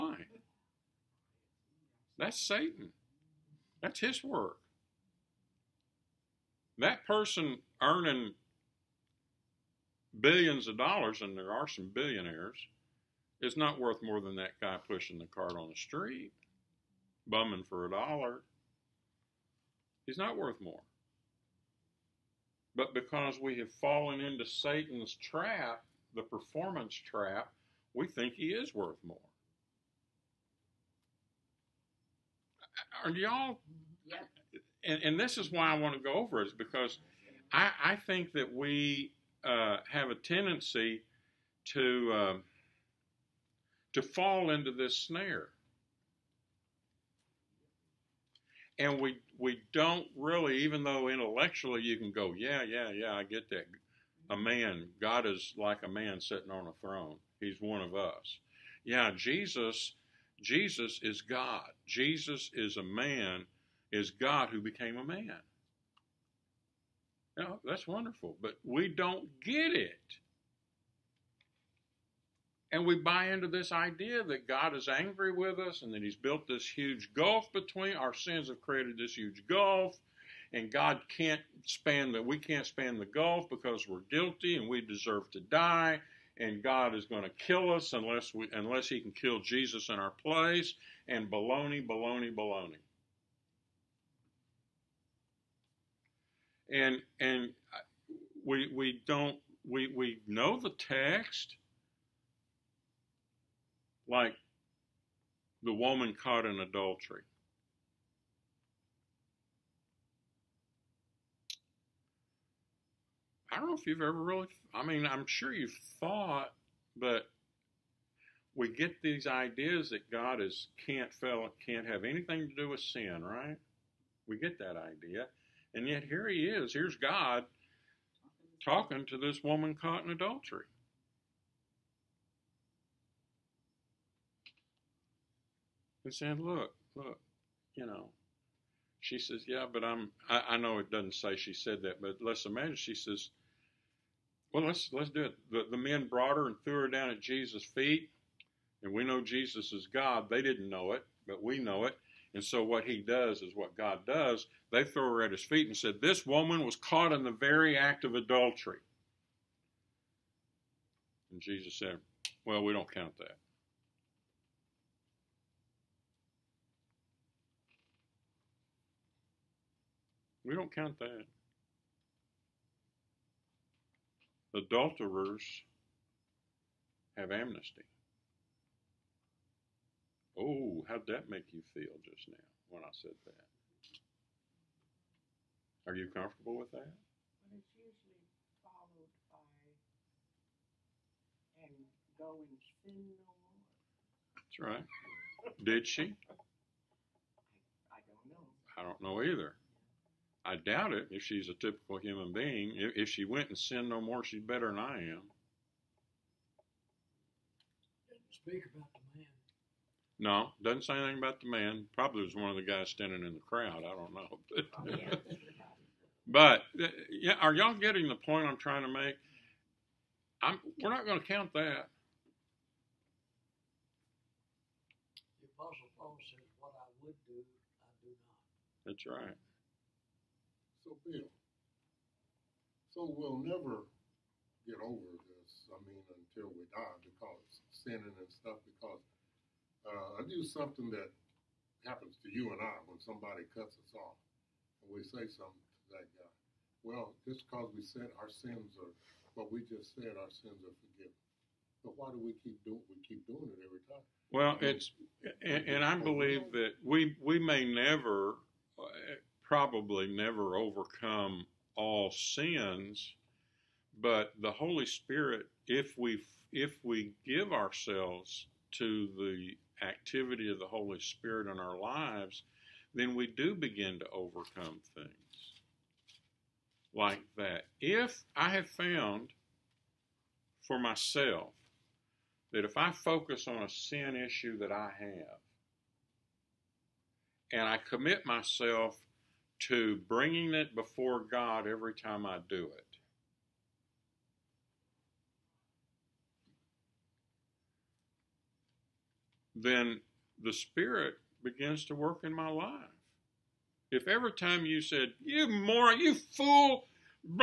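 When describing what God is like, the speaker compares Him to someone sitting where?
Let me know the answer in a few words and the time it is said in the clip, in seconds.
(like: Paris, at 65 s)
on a throne, at 56 s.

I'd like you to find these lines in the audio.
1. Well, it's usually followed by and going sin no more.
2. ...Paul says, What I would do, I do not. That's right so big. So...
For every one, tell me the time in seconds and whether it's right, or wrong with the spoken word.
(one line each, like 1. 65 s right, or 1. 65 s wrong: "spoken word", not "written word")
1. 186 s right
2. 225 s right.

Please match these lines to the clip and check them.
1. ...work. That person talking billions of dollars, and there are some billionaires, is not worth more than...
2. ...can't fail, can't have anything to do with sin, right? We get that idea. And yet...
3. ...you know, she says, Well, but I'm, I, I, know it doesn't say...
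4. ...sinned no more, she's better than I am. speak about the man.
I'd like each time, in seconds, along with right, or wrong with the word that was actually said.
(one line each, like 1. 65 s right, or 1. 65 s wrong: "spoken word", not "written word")
1. 4 s wrong: "earning", not "talking"
2. 120 s right
3. 137 s wrong: "Yeah", not "Well"
4. 203 s right.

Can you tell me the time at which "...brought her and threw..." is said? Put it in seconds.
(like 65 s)
146 s.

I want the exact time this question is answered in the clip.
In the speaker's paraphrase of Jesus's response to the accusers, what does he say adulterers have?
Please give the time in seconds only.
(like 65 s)
177 s.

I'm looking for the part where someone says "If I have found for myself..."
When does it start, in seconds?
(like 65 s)
277 s.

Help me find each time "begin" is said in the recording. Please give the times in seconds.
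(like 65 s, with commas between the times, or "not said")
273 s, 301 s.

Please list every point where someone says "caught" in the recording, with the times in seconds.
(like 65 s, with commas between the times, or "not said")
106 s, 129 s, 156 s.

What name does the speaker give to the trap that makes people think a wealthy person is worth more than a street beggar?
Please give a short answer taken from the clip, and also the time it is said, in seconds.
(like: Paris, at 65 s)
the performance trap, at 26 s.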